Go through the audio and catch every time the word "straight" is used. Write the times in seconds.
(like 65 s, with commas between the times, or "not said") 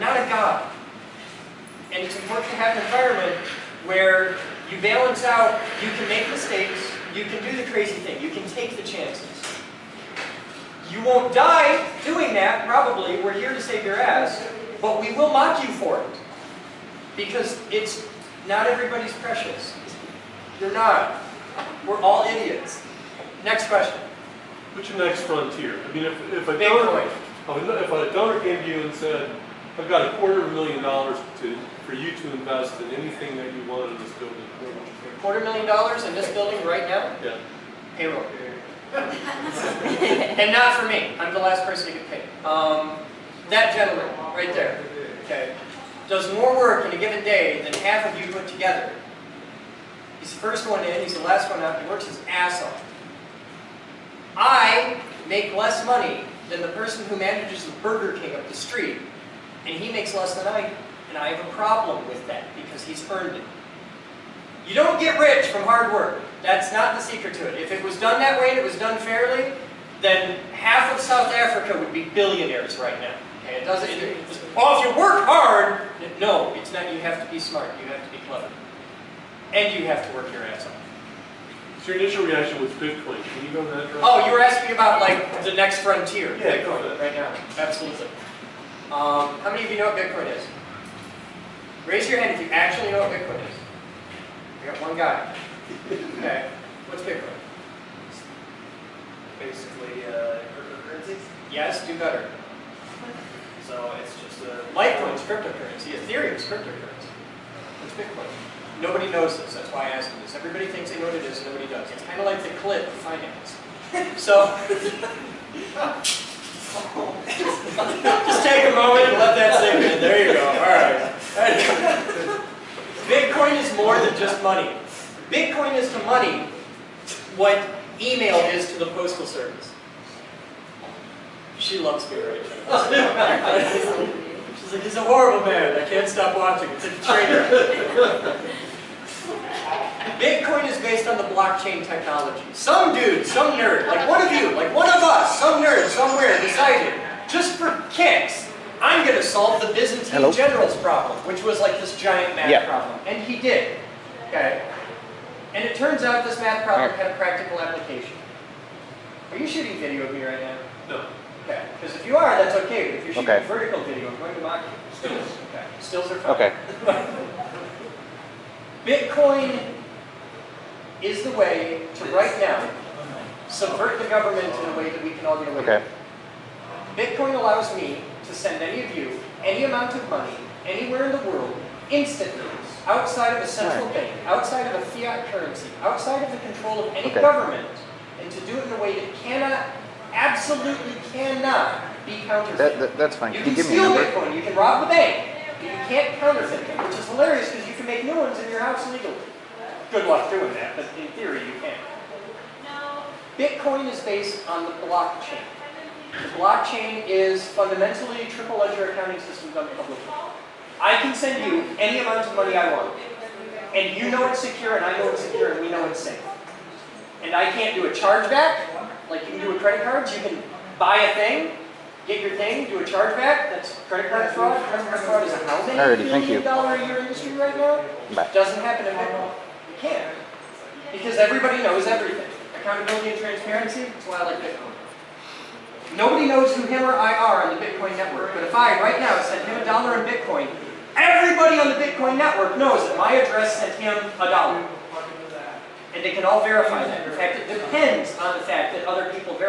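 not said.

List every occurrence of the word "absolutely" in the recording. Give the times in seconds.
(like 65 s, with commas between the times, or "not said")
87 s, 190 s.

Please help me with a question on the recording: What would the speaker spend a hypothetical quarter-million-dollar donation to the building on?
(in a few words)
Payroll.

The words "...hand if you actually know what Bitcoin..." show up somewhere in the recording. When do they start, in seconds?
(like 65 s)
92 s.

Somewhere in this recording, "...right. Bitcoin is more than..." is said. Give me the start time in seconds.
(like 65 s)
120 s.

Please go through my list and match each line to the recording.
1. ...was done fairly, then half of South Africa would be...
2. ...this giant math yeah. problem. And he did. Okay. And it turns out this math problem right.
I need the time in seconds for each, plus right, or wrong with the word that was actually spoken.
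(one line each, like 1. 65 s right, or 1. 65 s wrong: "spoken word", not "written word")
1. 68 s right
2. 151 s right.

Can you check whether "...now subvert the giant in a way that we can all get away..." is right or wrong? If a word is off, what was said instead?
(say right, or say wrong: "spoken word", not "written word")
wrong: "government", not "giant".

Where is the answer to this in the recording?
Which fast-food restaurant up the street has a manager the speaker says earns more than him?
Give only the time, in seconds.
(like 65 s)
57 s.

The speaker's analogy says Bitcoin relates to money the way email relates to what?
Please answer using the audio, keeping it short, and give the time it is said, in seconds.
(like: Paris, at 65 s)
The postal service, at 128 s.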